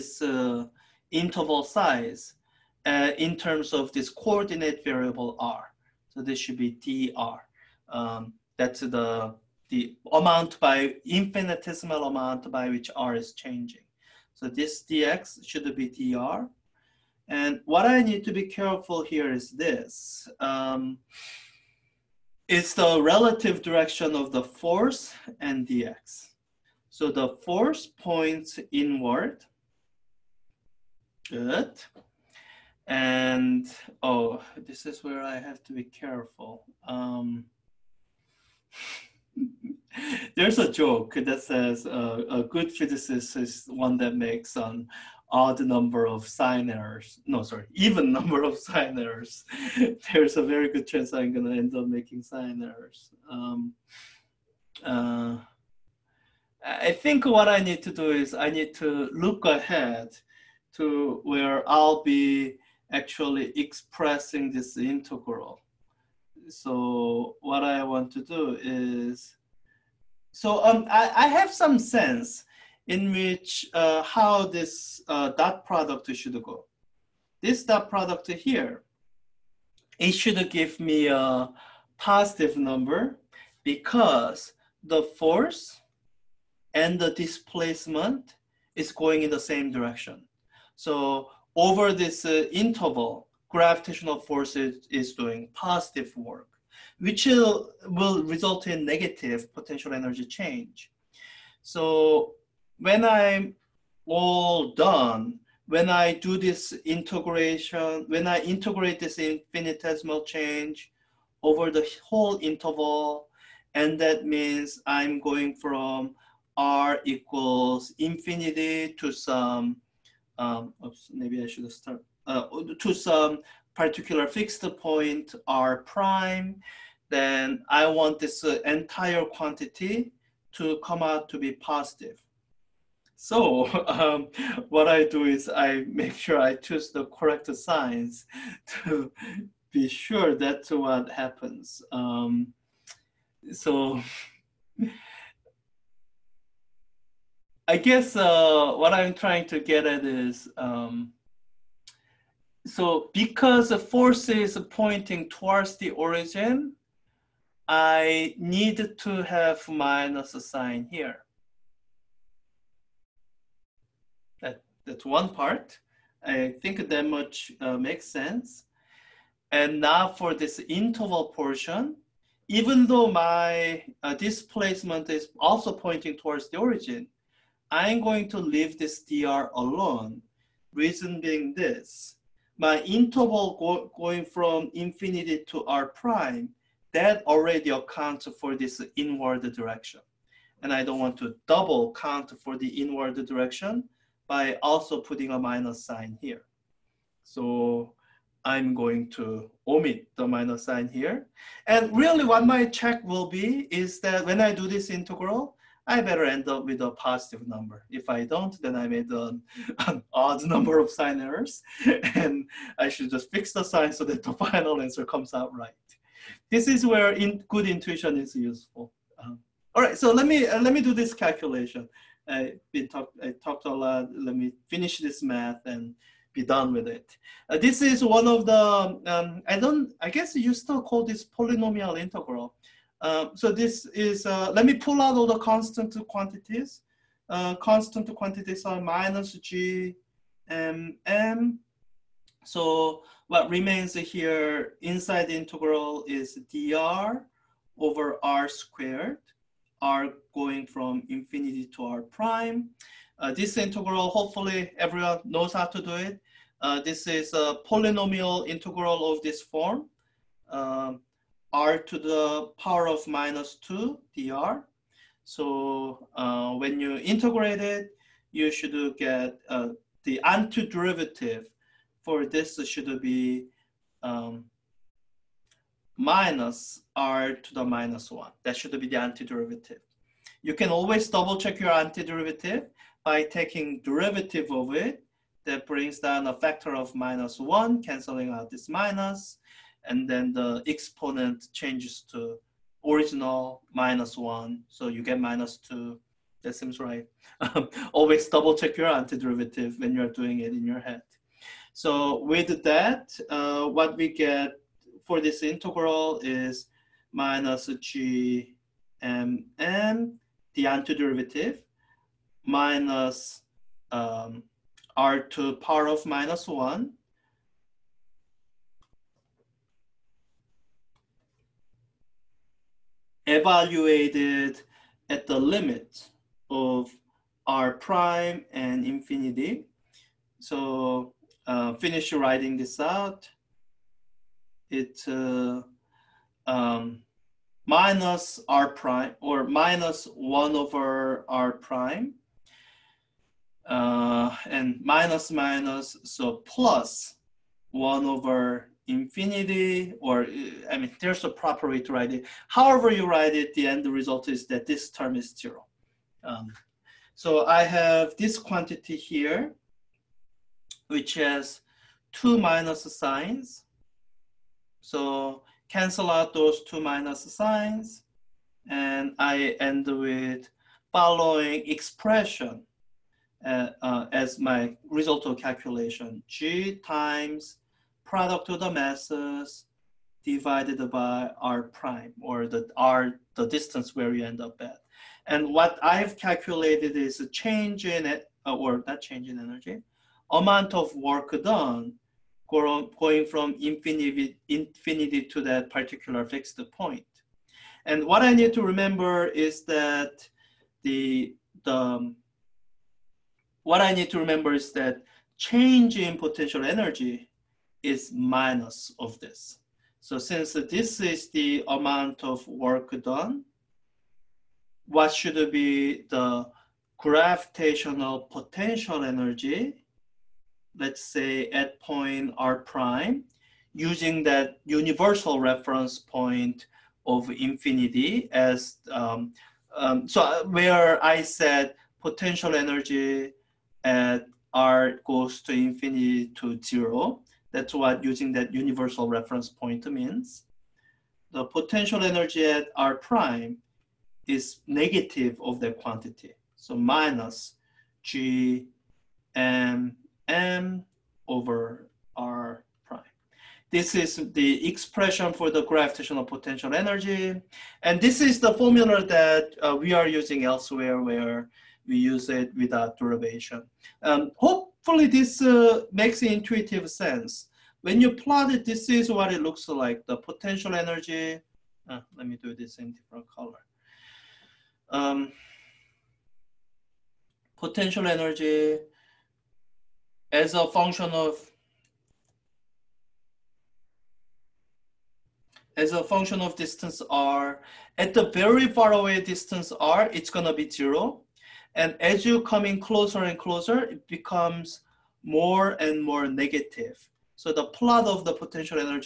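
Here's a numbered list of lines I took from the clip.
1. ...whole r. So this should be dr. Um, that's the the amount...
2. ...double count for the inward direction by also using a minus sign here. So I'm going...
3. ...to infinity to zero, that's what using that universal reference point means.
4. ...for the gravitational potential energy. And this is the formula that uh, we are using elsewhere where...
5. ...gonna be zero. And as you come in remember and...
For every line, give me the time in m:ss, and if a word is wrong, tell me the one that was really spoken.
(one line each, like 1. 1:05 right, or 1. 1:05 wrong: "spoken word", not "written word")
1. 0:04 wrong: "variable", not "whole"
2. 3:11 wrong: "putting", not "using"
3. 7:15 right
4. 7:35 right
5. 8:10 wrong: "closer", not "remember".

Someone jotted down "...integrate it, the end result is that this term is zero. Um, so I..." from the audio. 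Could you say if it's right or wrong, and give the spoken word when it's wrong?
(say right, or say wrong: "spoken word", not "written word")
wrong: "write", not "integrate".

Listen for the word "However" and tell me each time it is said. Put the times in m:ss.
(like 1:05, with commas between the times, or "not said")
5:52.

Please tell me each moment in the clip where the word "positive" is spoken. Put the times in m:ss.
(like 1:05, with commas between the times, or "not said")
1:21, 1:35, 2:11, 3:26.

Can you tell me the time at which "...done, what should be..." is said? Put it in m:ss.
6:53.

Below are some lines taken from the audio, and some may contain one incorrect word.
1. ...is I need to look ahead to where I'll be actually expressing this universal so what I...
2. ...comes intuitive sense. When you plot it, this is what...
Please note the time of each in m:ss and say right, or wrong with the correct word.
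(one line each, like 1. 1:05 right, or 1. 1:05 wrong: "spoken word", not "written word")
1. 0:58 wrong: "integral", not "universal"
2. 7:45 wrong: "makes", not "comes".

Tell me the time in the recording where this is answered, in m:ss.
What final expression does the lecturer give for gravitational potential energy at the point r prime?
7:26.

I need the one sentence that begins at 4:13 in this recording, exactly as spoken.
Uh, this integral, hopefully everyone knows how to do it.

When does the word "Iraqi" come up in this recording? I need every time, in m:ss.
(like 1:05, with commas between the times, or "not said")
not said.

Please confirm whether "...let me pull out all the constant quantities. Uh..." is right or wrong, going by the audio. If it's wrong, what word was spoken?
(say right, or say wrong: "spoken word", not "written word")
right.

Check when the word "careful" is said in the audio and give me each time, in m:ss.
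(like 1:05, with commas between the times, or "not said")
0:18, 0:36.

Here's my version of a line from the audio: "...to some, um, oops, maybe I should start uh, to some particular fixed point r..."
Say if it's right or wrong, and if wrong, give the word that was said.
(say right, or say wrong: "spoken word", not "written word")
right.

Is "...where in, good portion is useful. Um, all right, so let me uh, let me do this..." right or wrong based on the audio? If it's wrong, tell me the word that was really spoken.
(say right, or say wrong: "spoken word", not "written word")
wrong: "intuition", not "portion".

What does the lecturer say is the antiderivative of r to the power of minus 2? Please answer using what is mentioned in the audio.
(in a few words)
minus r to the minus 1.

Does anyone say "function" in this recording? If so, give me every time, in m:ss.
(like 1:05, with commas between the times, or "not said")
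8:00, 8:06.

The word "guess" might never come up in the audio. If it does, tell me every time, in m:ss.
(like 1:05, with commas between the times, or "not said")
2:27, 3:50.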